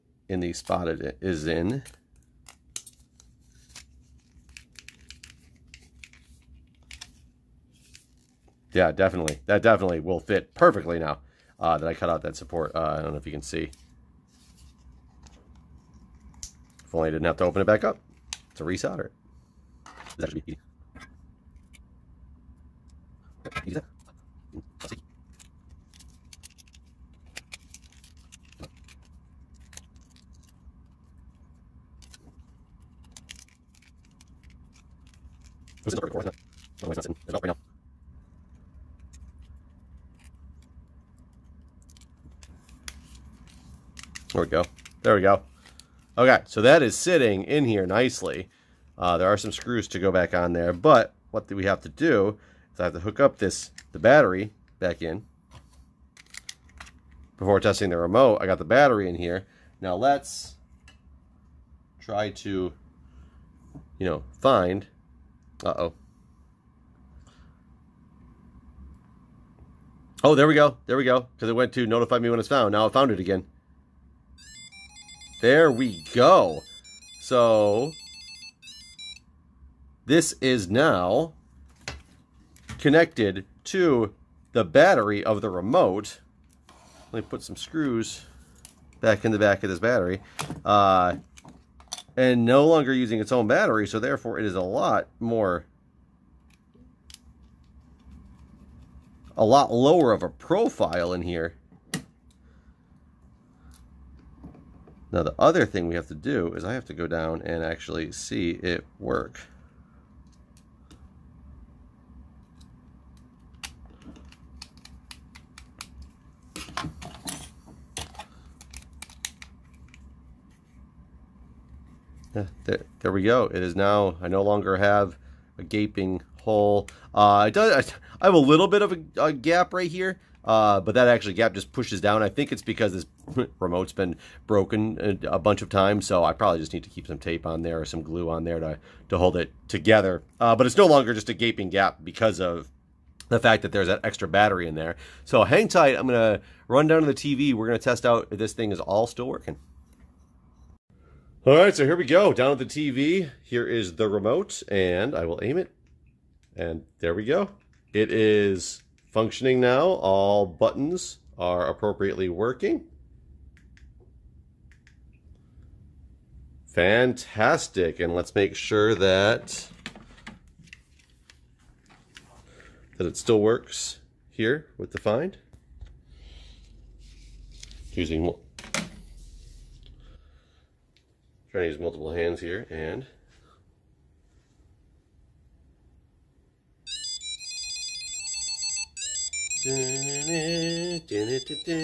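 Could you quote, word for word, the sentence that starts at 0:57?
Before testing the remote, I got the battery in here.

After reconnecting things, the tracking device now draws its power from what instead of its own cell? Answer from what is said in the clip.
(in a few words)
the battery of the remote.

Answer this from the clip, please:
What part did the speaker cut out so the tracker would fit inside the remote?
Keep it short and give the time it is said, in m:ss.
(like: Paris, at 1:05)
that support, at 0:12.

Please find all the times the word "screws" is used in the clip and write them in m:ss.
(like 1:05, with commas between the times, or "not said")
0:49, 1:27.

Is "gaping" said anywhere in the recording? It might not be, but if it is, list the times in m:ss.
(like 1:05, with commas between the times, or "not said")
2:05, 2:21.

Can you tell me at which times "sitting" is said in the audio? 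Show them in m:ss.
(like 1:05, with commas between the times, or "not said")
0:37, 0:46.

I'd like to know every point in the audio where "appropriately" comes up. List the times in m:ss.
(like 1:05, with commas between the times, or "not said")
2:41.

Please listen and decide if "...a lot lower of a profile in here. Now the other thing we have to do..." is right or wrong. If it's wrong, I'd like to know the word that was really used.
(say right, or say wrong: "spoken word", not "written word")
right.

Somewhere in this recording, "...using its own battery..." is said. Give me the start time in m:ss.
1:32.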